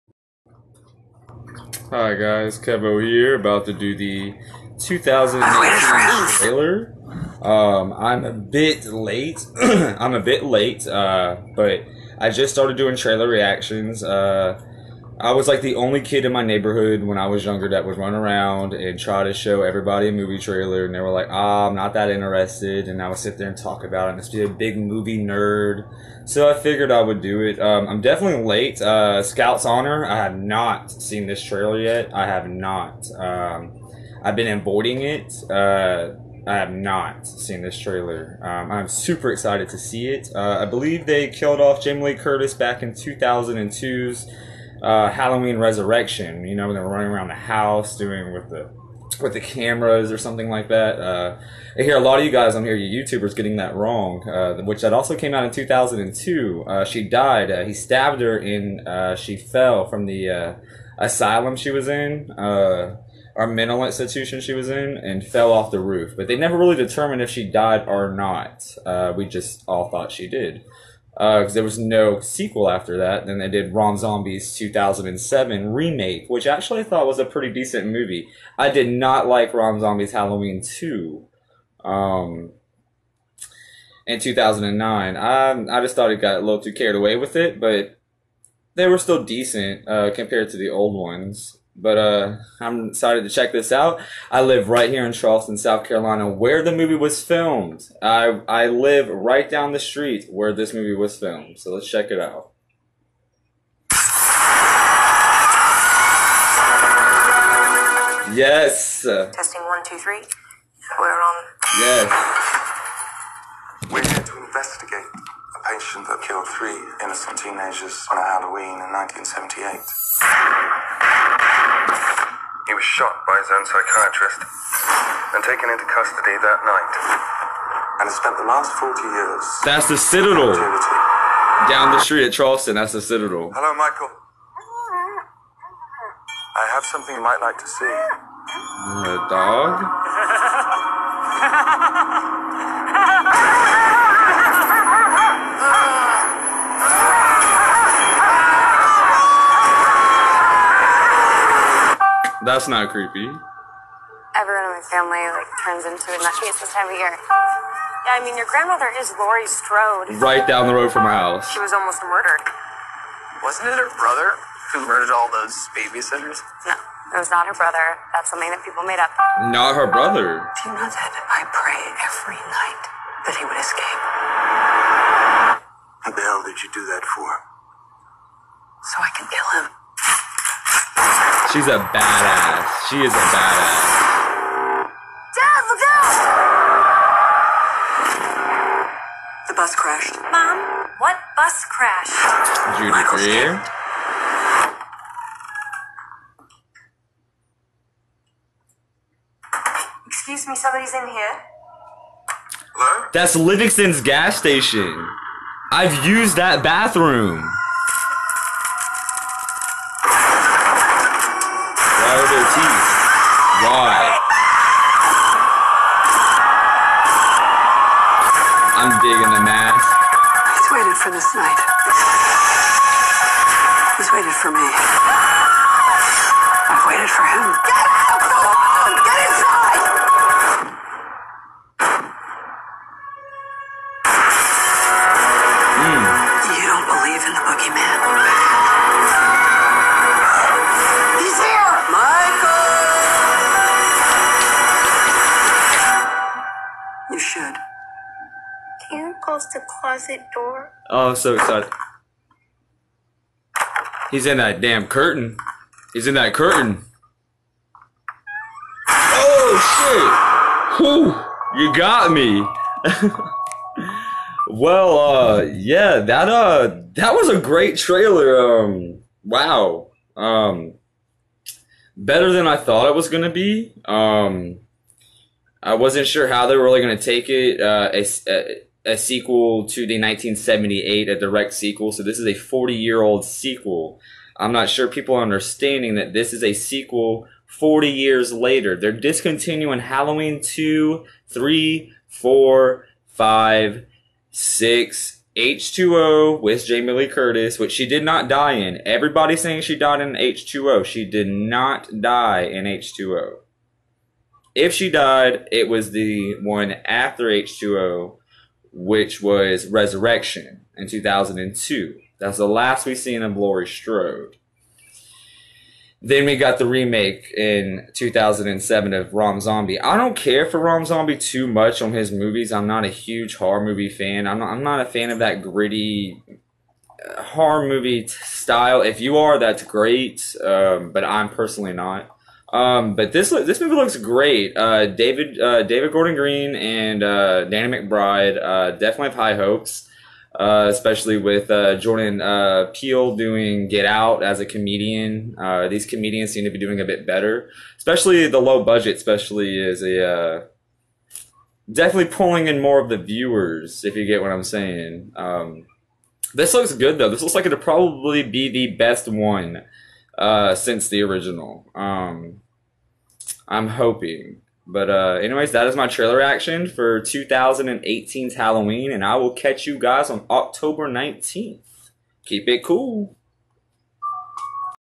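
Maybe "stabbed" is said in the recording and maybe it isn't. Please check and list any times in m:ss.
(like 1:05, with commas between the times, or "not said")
0:57.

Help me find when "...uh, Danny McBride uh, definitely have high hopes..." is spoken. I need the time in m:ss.
5:37.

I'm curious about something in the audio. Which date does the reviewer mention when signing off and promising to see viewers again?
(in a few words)
October 19th.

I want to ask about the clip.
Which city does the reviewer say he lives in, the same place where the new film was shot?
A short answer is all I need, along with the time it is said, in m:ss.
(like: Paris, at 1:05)
Charleston, South Carolina, at 1:35.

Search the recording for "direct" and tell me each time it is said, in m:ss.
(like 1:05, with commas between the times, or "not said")
4:41.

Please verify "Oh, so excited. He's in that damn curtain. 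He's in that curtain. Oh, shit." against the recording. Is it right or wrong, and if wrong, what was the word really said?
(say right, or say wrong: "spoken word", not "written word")
right.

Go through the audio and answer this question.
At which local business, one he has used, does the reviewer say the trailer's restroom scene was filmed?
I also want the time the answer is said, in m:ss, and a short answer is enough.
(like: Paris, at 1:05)
Livingston's gas station, at 3:23.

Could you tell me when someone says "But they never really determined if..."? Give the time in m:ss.
1:06.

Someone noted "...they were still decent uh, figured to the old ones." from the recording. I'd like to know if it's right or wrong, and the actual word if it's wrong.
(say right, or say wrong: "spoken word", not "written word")
wrong: "compared", not "figured".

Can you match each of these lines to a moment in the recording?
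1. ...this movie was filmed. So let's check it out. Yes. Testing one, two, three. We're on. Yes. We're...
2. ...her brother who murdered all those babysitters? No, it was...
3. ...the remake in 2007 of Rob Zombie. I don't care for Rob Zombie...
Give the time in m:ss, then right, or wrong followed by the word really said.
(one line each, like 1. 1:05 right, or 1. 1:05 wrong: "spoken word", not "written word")
1. 1:40 right
2. 2:43 right
3. 5:16 right.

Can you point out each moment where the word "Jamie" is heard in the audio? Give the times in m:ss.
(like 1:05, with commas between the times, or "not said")
0:41, 4:56.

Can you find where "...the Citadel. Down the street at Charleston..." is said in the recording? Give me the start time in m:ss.
2:09.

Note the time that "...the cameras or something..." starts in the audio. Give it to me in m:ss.
0:49.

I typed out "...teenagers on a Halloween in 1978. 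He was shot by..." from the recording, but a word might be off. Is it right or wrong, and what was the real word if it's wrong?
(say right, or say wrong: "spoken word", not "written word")
right.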